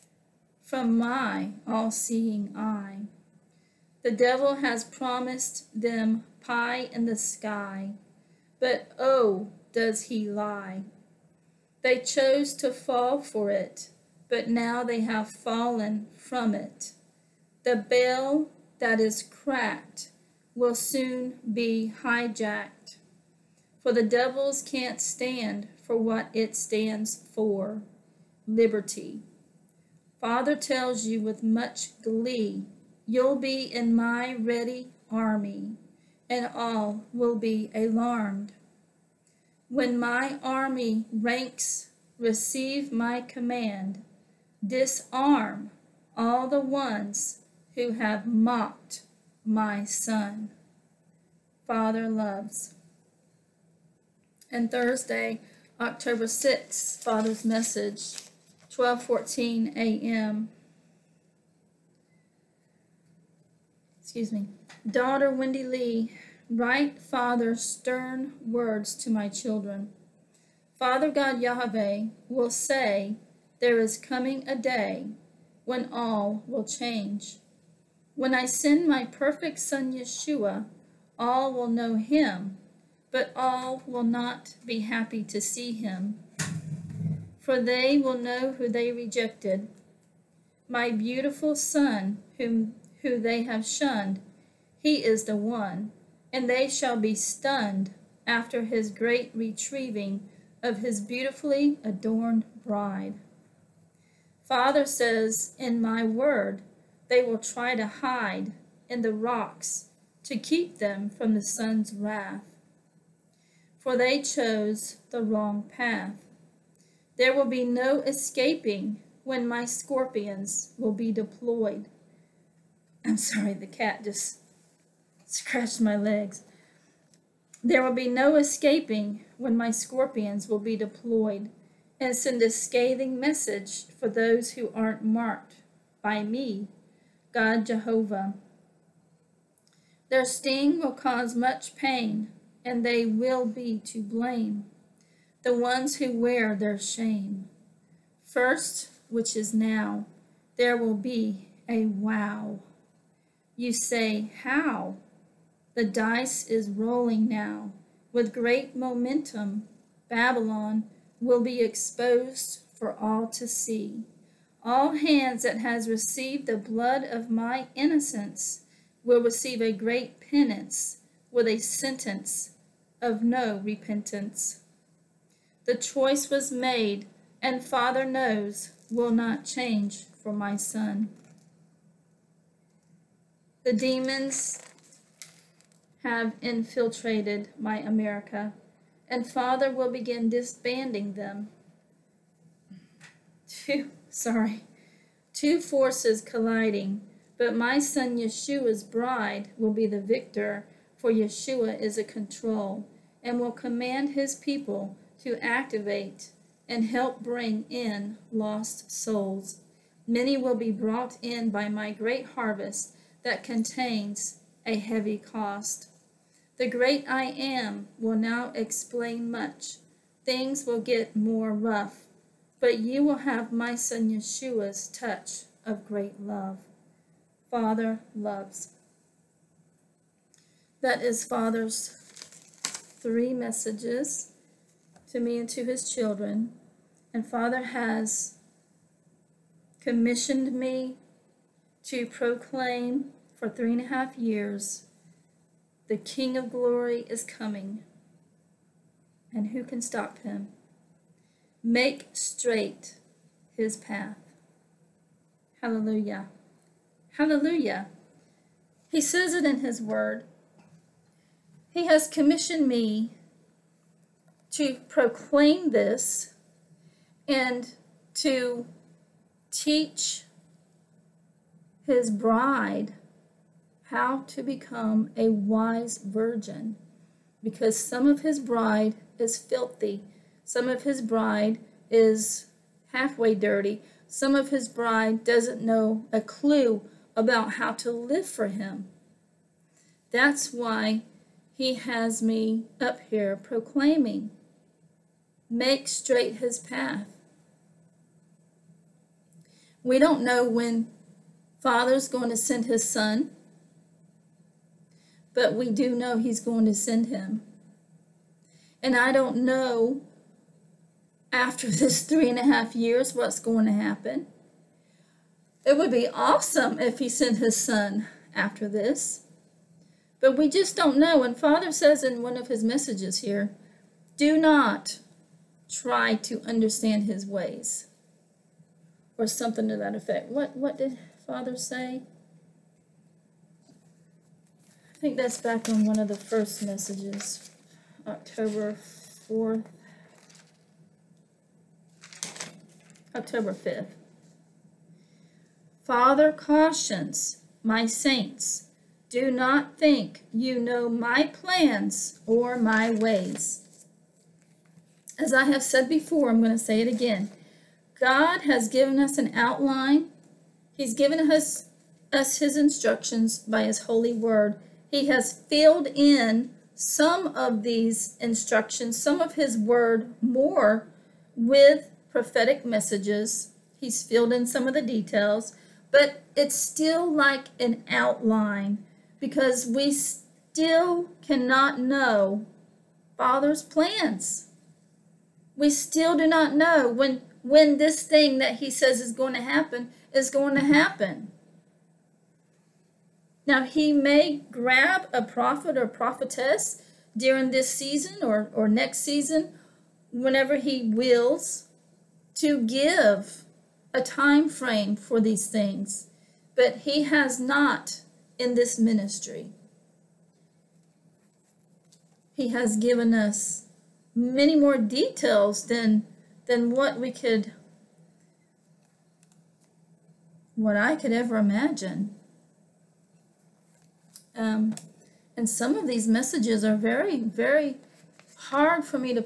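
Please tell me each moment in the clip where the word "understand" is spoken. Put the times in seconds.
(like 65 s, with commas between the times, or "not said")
326 s.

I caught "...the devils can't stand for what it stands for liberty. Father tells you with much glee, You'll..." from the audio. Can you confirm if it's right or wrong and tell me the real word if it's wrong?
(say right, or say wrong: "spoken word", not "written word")
right.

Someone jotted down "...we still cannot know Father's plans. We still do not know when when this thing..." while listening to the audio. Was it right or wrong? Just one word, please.
right.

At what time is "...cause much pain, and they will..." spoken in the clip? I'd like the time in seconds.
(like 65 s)
140 s.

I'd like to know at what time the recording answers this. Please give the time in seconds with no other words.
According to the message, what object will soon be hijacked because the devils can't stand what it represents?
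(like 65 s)
17 s.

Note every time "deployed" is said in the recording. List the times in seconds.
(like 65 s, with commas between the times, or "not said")
121 s, 130 s.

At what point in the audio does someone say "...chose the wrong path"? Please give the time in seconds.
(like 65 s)
114 s.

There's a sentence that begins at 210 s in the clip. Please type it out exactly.
Many will be brought in by my great harvest that contains a heavy cost.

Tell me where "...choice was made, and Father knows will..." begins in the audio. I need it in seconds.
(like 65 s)
175 s.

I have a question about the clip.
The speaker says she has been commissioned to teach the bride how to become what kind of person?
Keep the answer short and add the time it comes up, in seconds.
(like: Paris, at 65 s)
A wise virgin, at 275 s.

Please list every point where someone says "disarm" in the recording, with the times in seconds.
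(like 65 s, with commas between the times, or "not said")
44 s.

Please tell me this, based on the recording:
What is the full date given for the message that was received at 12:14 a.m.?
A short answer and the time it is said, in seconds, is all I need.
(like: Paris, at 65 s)
Thursday, October 6th, at 54 s.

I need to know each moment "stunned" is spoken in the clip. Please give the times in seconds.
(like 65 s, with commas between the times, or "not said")
97 s.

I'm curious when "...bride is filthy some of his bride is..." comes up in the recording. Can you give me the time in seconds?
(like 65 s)
278 s.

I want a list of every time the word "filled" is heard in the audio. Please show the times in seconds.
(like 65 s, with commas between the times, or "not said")
365 s, 374 s.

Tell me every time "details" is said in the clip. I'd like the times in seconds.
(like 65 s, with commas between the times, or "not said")
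374 s, 414 s.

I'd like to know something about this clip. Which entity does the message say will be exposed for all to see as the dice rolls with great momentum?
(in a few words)
Babylon.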